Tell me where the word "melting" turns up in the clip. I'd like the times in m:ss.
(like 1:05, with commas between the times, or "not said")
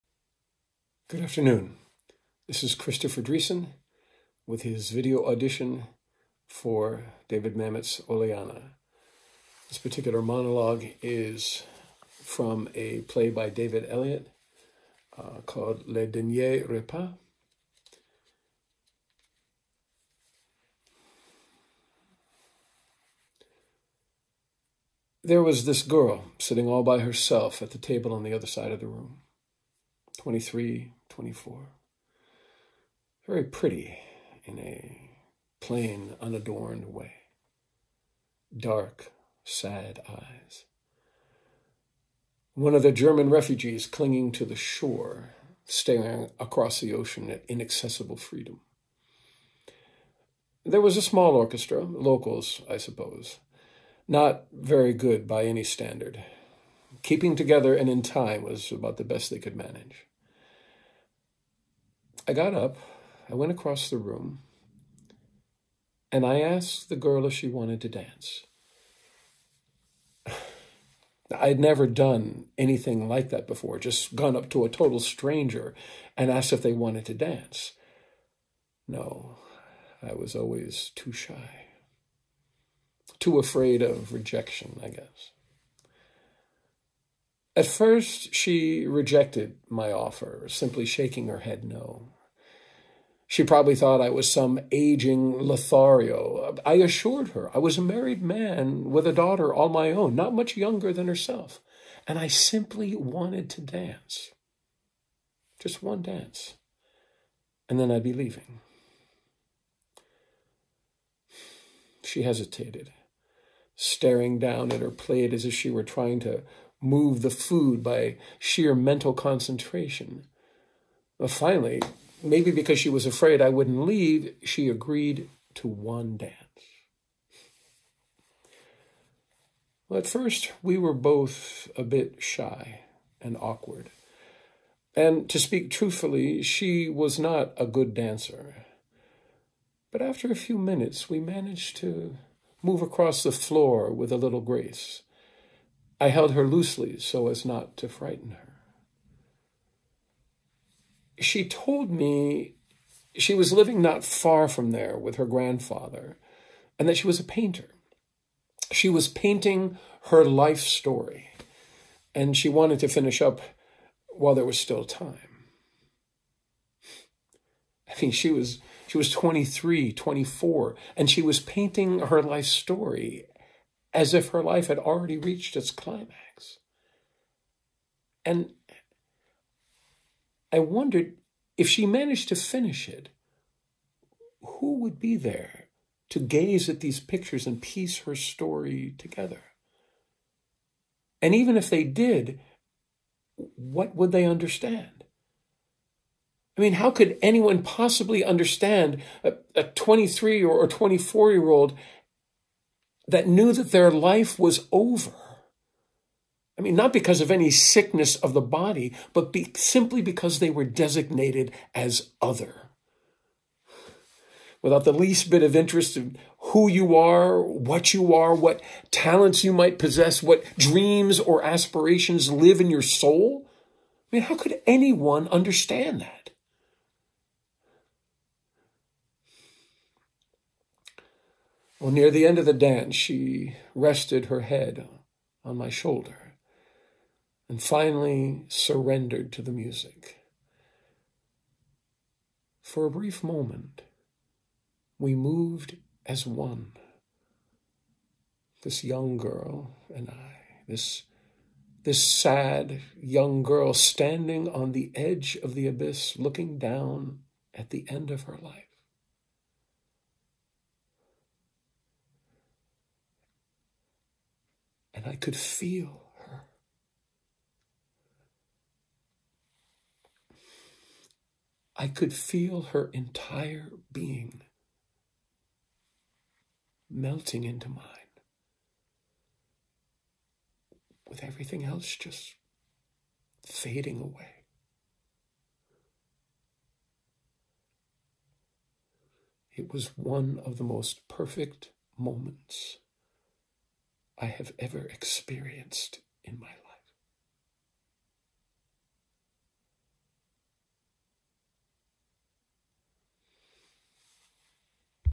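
4:36.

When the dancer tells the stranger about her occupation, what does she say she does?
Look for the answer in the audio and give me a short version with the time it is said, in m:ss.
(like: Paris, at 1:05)
painter, at 2:37.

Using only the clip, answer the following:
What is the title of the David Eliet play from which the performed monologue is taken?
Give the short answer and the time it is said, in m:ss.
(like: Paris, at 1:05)
Le Dernier Repas, at 0:15.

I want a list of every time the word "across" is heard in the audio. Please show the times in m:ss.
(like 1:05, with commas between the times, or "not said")
0:46, 1:03, 2:22.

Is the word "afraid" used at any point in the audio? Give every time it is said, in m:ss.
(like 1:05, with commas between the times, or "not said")
1:23, 2:03.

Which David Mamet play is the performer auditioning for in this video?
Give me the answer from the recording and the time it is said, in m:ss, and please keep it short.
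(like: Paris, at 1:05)
Oleanna, at 0:08.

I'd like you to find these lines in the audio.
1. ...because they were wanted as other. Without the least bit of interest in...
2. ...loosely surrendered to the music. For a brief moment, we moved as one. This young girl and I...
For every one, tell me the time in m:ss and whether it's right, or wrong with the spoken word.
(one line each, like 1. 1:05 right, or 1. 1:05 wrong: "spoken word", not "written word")
1. 3:30 wrong: "designated", not "wanted"
2. 3:57 wrong: "finally", not "loosely".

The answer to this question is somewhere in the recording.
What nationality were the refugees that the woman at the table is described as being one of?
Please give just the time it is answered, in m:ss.
0:42.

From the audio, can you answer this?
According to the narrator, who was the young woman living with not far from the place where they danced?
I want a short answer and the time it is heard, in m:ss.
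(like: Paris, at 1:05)
her grandfather, at 2:35.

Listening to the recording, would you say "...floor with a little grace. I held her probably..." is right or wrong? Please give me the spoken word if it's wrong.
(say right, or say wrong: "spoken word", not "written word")
wrong: "loosely", not "probably".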